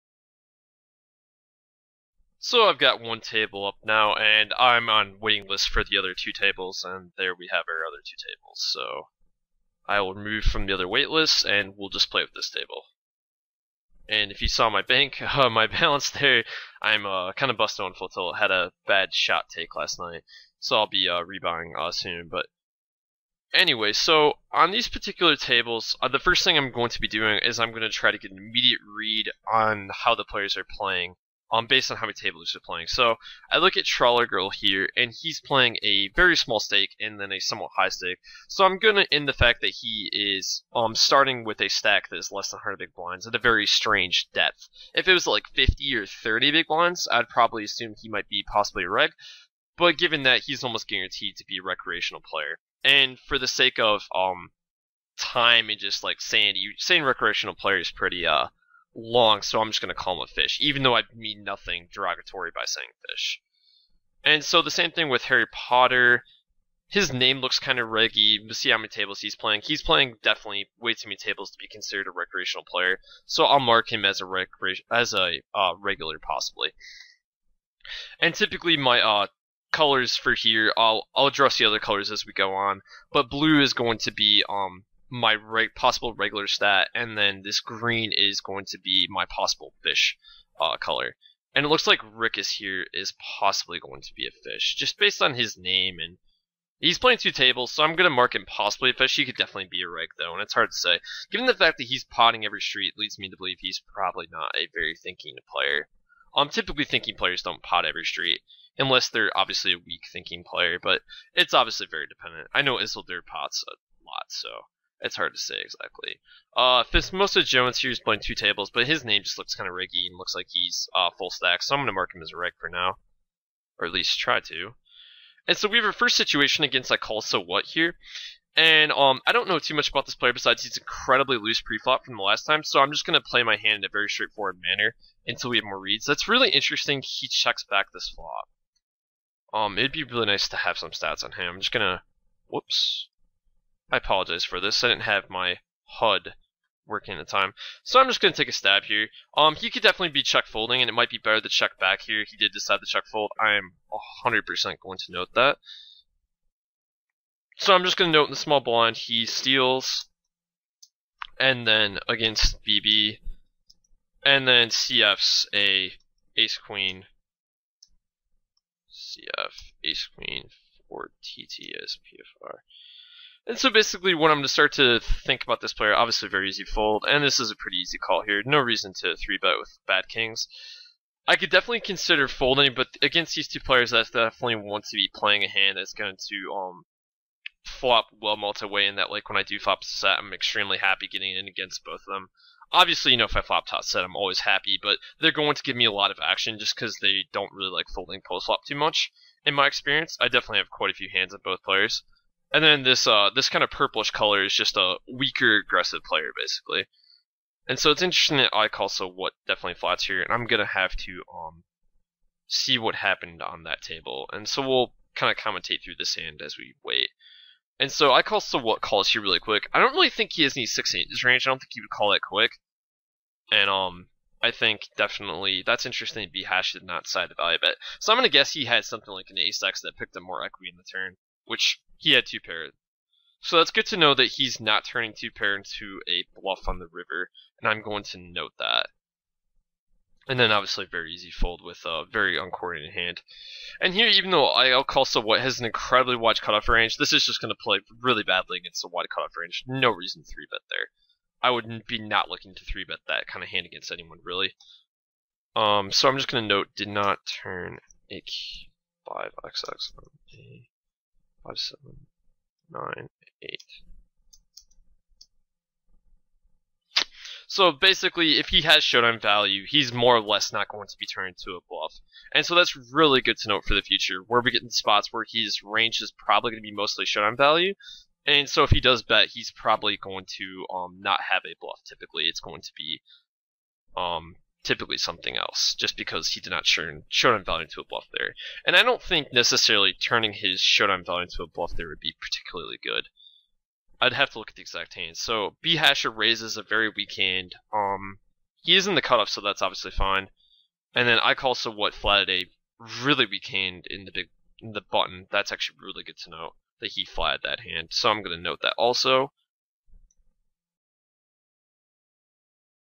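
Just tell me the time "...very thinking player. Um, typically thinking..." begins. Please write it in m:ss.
1:44.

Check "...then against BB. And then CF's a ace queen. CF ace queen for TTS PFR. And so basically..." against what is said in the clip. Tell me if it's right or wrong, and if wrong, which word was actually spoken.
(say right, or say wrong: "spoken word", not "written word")
right.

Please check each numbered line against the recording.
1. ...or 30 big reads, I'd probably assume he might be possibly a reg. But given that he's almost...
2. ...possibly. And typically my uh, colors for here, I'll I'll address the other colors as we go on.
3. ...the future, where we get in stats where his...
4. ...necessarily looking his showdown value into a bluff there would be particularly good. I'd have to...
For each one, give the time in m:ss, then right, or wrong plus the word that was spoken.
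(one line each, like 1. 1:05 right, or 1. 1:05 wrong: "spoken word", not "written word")
1. 0:45 wrong: "blinds", not "reads"
2. 1:16 right
3. 4:33 wrong: "spots", not "stats"
4. 4:49 wrong: "turning", not "looking".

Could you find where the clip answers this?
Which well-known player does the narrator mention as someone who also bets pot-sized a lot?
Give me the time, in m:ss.
1:52.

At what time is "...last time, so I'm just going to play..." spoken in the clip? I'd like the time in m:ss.
2:12.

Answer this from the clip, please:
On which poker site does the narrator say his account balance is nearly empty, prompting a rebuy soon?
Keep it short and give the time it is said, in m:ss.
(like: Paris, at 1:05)
Full Tilt, at 0:17.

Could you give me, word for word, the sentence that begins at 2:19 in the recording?
Um, it'd be really nice to have some stats on him.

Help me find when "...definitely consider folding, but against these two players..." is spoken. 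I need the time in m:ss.
3:01.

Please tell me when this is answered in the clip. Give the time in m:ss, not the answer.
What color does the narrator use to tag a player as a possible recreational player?
1:27.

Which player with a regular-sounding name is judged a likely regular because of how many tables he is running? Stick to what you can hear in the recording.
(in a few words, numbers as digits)
Harry Potter.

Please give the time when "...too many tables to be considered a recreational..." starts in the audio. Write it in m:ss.
1:10.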